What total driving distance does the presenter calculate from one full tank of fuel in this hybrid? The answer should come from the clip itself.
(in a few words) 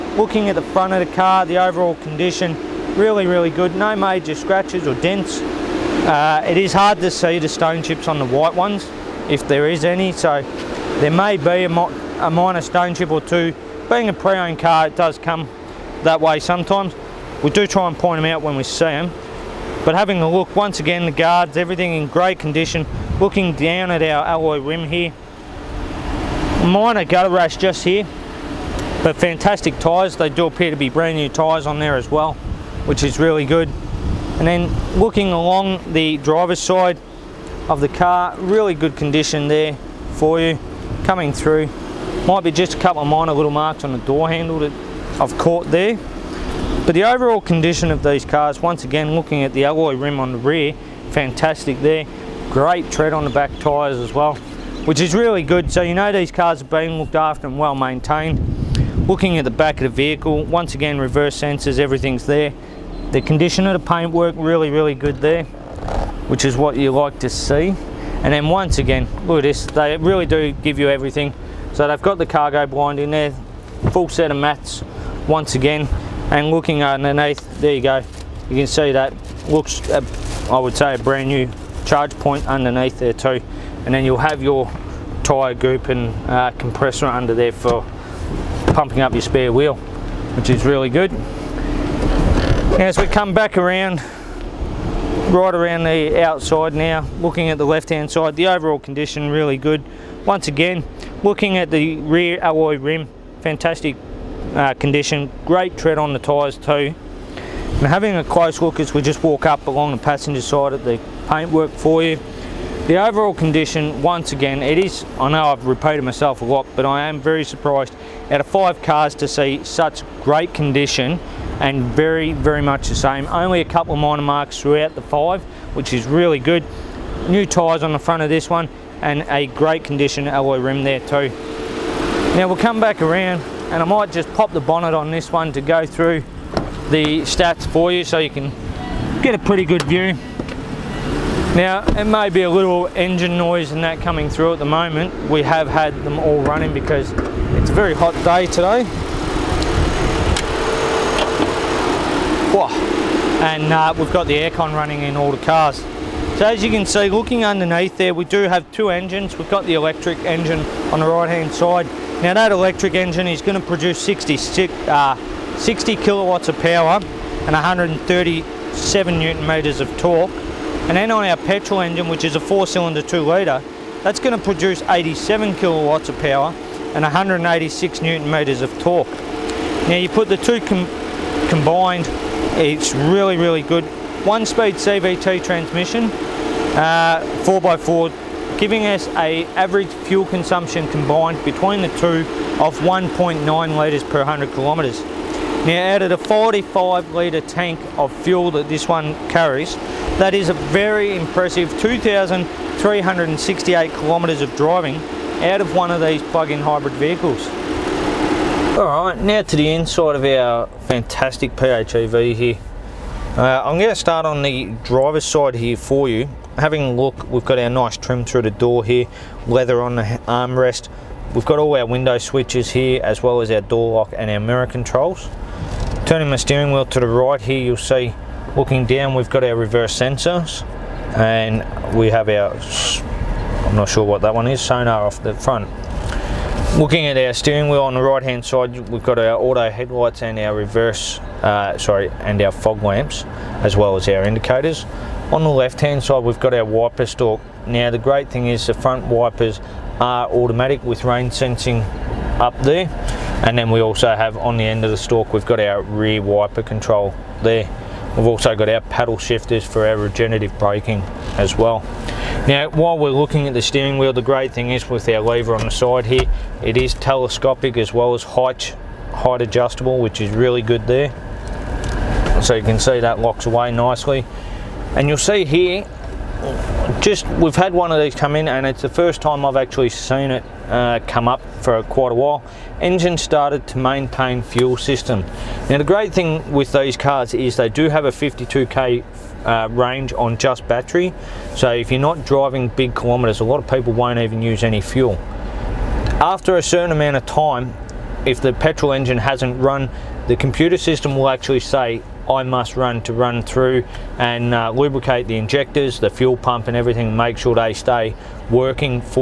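2,368 km.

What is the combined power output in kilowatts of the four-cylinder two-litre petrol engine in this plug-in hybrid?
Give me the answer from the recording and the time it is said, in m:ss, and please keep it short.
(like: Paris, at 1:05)
87 kW, at 2:54.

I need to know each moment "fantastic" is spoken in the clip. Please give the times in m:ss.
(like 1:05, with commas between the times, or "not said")
0:29, 0:51, 1:43, 3:30.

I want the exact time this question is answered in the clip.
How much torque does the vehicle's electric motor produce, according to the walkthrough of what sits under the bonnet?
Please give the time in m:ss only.
2:47.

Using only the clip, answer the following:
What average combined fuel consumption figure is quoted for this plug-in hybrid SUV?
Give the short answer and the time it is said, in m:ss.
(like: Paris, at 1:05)
1.9 L/100 km, at 3:12.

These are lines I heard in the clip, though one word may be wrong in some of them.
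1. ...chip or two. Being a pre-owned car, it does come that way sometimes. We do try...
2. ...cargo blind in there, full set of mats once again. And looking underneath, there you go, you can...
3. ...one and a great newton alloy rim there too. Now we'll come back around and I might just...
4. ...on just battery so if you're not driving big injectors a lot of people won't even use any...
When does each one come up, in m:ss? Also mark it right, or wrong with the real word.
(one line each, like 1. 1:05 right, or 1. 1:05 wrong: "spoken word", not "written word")
1. 0:12 right
2. 1:12 right
3. 2:08 wrong: "condition", not "newton"
4. 4:50 wrong: "kilometers", not "injectors".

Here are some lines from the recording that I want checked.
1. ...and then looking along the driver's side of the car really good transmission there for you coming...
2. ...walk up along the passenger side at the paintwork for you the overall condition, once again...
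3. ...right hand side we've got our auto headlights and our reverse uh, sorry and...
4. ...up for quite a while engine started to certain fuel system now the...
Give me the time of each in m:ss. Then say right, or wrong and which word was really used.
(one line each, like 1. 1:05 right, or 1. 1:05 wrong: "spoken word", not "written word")
1. 0:34 wrong: "condition", not "transmission"
2. 1:49 right
3. 3:58 right
4. 4:41 wrong: "maintain", not "certain".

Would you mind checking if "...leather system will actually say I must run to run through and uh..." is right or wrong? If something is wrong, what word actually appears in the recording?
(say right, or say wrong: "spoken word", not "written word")
wrong: "computer", not "leather".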